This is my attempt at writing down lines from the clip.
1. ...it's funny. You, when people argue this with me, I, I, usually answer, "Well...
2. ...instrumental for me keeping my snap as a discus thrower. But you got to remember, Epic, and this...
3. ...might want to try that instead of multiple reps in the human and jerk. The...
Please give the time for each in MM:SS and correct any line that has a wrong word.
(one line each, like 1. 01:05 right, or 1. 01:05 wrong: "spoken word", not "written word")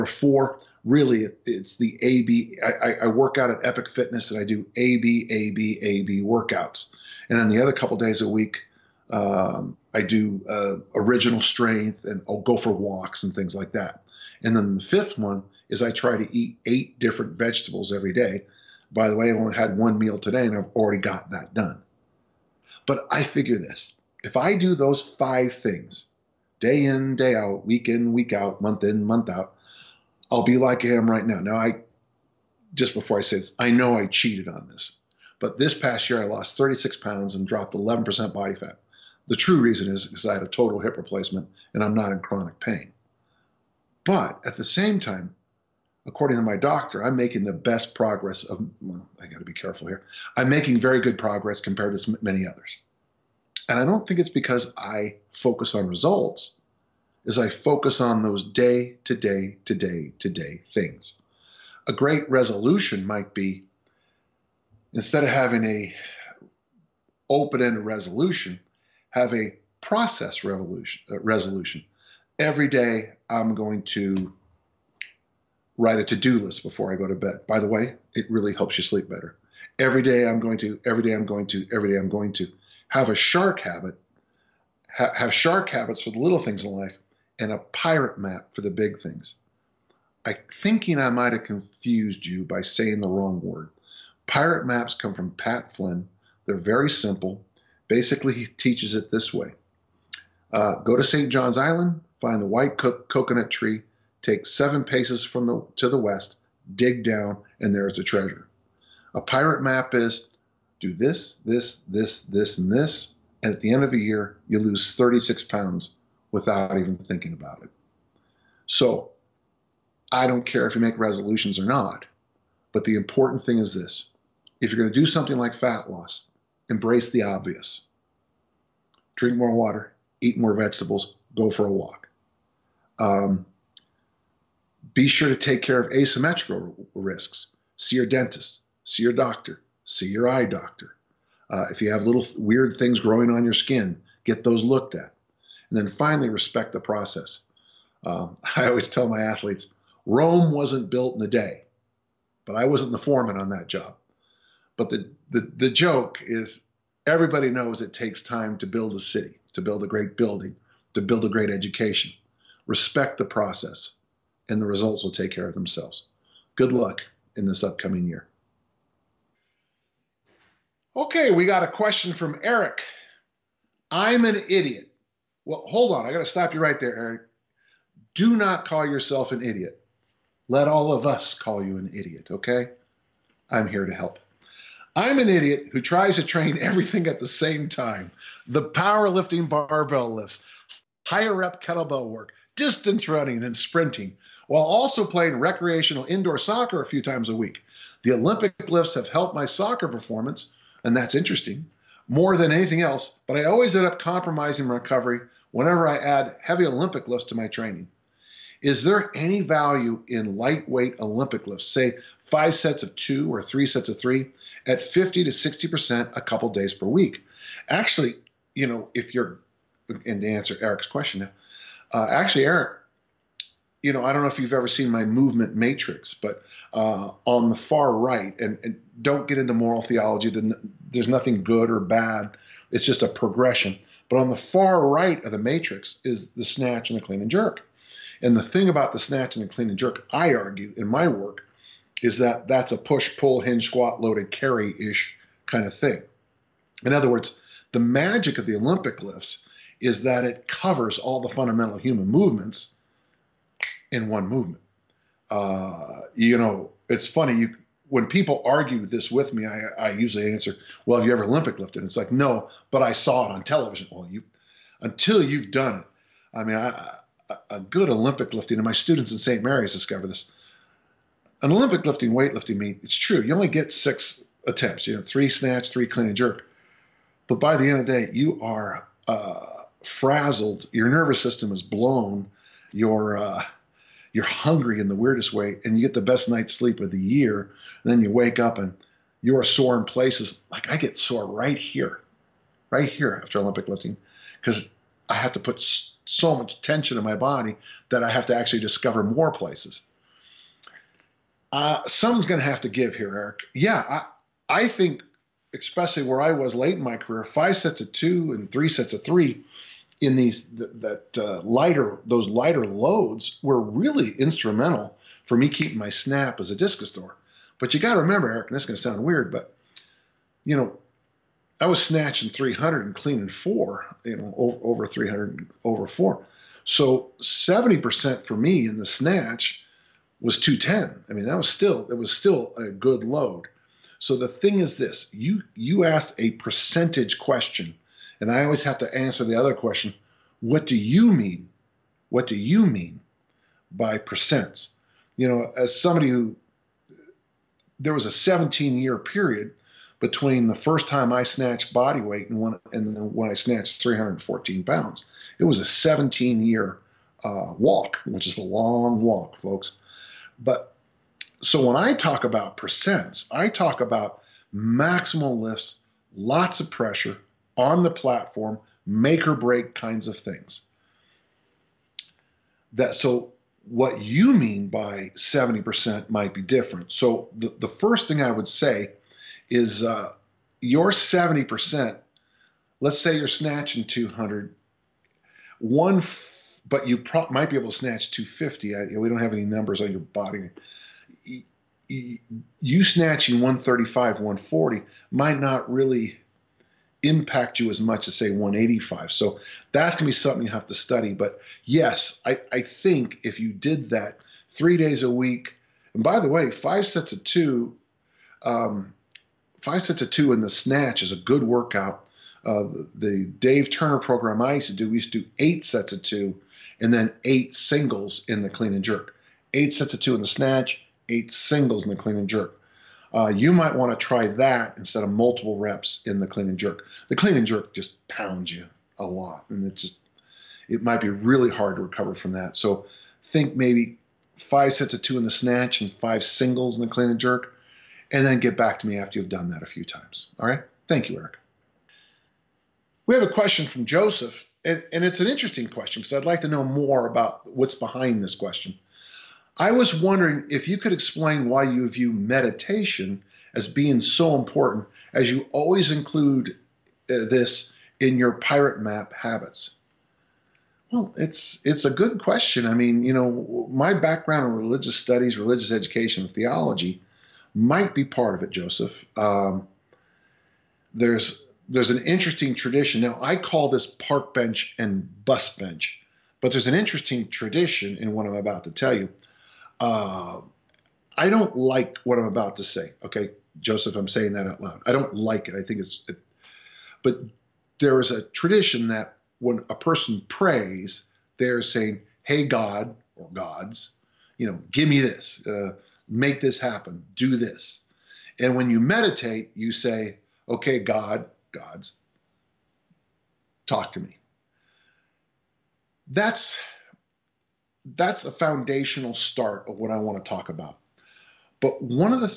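1. 04:16 right
2. 05:14 wrong: "Eric", not "Epic"
3. 07:03 wrong: "clean", not "human".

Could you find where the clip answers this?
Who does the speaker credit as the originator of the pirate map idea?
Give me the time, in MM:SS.
01:35.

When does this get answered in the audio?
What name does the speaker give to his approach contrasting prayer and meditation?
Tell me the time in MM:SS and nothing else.
07:53.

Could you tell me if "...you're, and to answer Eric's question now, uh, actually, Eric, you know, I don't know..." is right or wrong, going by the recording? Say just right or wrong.
right.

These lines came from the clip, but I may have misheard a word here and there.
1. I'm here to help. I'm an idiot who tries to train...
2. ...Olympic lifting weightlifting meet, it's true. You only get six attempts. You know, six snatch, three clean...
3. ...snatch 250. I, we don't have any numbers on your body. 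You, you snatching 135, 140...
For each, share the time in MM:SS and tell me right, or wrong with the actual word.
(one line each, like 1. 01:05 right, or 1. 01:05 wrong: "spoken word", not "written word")
1. 03:03 right
2. 04:31 wrong: "three", not "six"
3. 06:27 right.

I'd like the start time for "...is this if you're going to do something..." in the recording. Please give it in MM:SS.
02:03.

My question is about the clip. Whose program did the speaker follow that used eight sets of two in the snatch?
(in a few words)
Dave Turner.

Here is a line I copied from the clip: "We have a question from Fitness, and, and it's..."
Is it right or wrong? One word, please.
wrong.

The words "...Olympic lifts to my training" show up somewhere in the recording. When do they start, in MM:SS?
03:26.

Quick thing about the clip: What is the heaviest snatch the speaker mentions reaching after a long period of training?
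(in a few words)
314 pounds.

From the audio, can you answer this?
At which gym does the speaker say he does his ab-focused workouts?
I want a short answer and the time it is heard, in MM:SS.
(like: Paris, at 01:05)
Epic Fitness, at 00:03.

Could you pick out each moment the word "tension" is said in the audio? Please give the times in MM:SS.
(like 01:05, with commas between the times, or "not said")
04:56.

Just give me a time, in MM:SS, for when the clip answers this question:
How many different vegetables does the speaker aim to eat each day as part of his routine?
00:16.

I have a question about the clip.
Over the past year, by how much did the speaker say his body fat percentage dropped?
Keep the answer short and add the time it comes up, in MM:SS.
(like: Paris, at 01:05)
11%, at 00:37.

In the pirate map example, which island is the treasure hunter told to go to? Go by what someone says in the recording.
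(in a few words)
St. John's Island.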